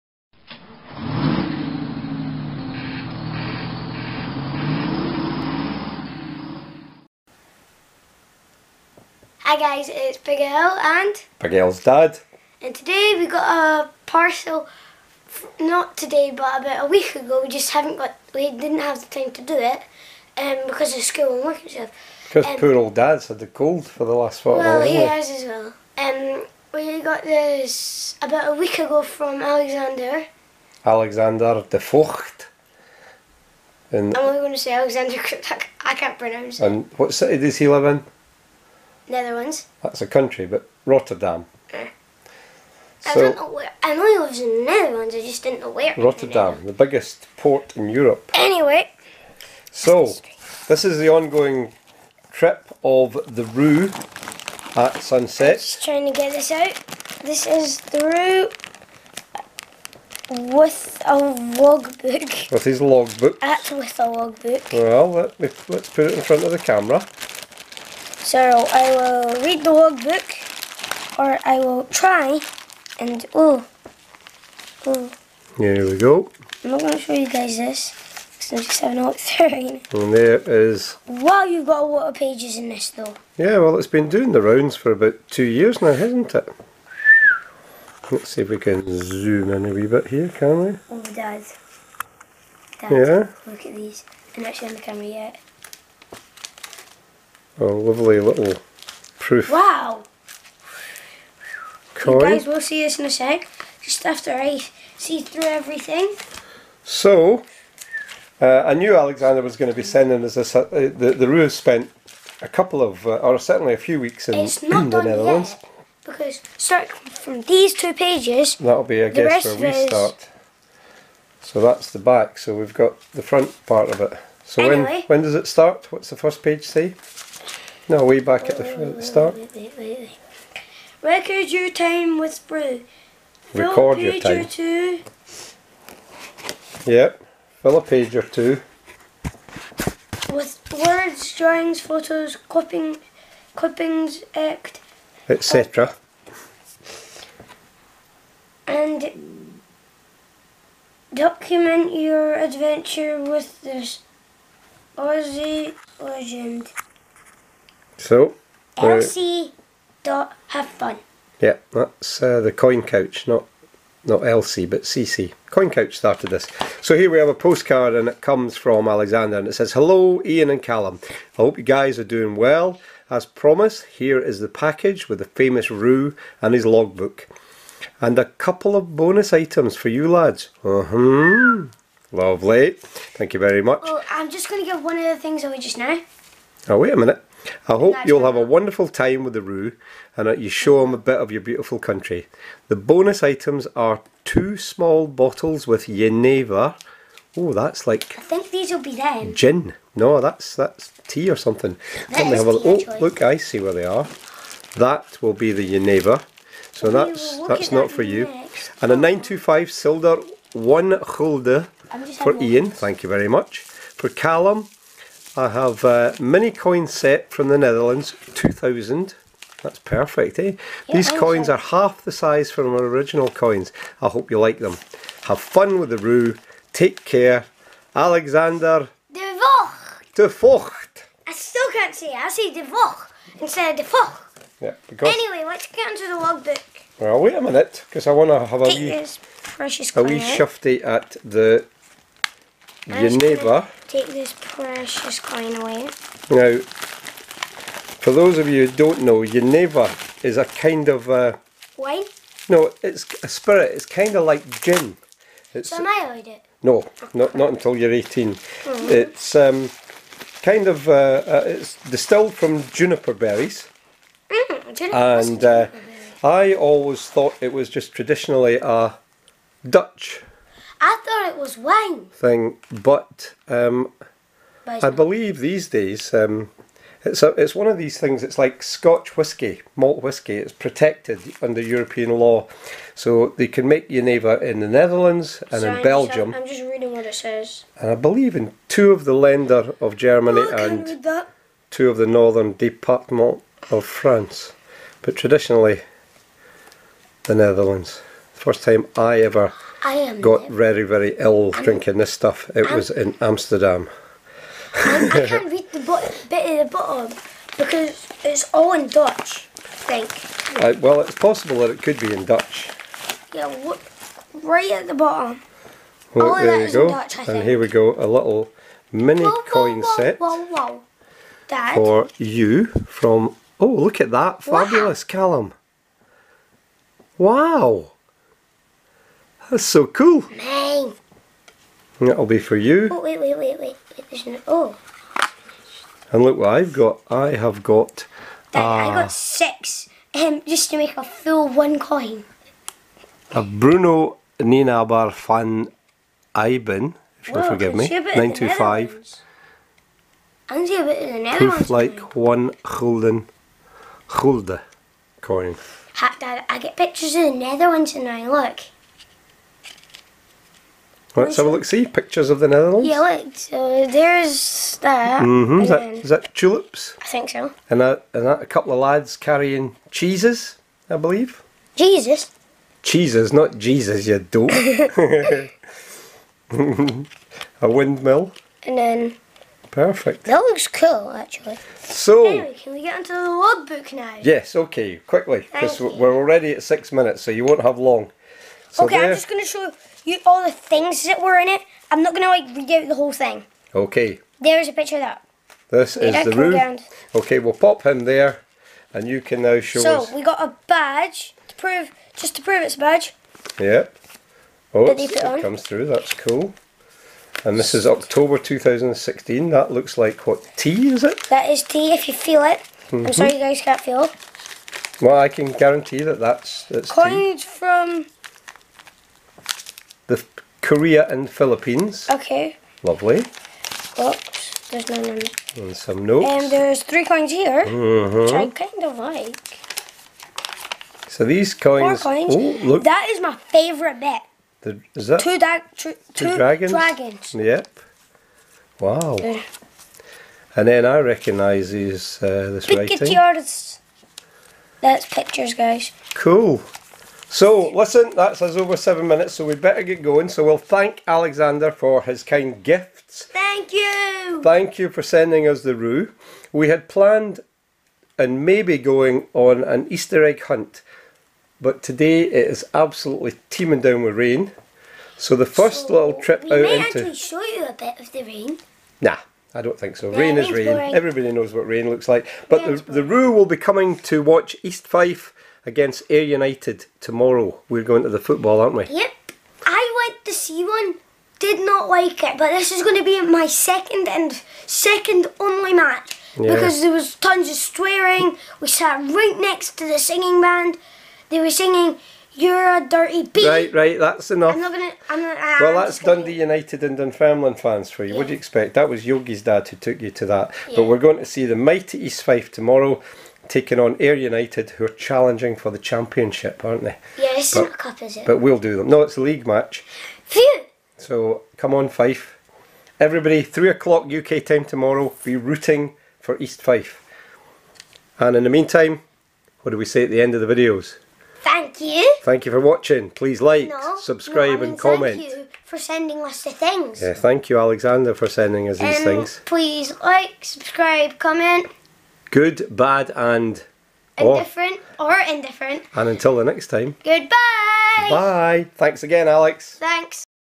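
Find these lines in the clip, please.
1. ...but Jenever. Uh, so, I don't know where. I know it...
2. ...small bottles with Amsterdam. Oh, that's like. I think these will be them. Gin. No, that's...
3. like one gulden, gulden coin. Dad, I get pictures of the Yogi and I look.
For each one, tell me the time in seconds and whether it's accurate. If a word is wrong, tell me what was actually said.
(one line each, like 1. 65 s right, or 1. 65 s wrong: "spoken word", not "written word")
1. 40 s wrong: "Rotterdam", not "Jenever"
2. 194 s wrong: "Jenever", not "Amsterdam"
3. 351 s wrong: "Netherlands", not "Yogi".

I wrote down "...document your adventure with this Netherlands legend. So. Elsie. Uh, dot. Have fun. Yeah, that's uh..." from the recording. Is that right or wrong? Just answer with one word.
wrong.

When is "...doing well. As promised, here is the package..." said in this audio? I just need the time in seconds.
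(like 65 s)
172 s.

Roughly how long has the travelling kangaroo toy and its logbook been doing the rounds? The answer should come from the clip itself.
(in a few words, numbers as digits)
about two years.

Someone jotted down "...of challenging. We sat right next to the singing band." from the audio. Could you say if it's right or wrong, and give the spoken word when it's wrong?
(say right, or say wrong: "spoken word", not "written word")
wrong: "swearing", not "challenging".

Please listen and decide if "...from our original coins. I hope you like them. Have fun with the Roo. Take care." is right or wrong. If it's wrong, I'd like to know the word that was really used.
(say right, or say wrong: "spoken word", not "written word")
right.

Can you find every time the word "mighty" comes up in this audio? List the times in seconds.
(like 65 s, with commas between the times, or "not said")
501 s.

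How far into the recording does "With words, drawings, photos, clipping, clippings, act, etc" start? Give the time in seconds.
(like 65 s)
140 s.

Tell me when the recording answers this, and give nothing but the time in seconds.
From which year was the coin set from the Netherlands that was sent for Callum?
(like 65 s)
218 s.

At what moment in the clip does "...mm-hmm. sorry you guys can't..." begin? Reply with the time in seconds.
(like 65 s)
413 s.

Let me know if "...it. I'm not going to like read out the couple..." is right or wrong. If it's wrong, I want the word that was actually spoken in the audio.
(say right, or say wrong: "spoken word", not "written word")
wrong: "whole", not "couple".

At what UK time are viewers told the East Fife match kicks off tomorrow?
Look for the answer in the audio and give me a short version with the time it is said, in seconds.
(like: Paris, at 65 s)
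3 o'clock, at 513 s.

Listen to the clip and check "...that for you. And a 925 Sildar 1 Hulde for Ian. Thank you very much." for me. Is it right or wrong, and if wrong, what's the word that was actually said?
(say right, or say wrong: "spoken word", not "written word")
right.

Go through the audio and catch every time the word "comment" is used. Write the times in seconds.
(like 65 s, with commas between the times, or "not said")
524 s, 531 s.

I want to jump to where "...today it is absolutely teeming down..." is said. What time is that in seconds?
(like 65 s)
461 s.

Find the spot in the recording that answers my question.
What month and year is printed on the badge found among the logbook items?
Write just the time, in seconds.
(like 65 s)
407 s.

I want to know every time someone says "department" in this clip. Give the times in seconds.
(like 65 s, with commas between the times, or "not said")
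292 s.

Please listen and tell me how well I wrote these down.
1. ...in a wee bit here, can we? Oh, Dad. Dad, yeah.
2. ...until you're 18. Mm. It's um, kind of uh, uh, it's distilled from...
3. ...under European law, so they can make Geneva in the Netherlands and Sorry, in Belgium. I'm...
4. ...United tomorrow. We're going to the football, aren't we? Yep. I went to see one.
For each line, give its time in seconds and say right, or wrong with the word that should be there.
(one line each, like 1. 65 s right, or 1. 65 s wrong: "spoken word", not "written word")
1. 89 s right
2. 257 s right
3. 281 s right
4. 476 s right.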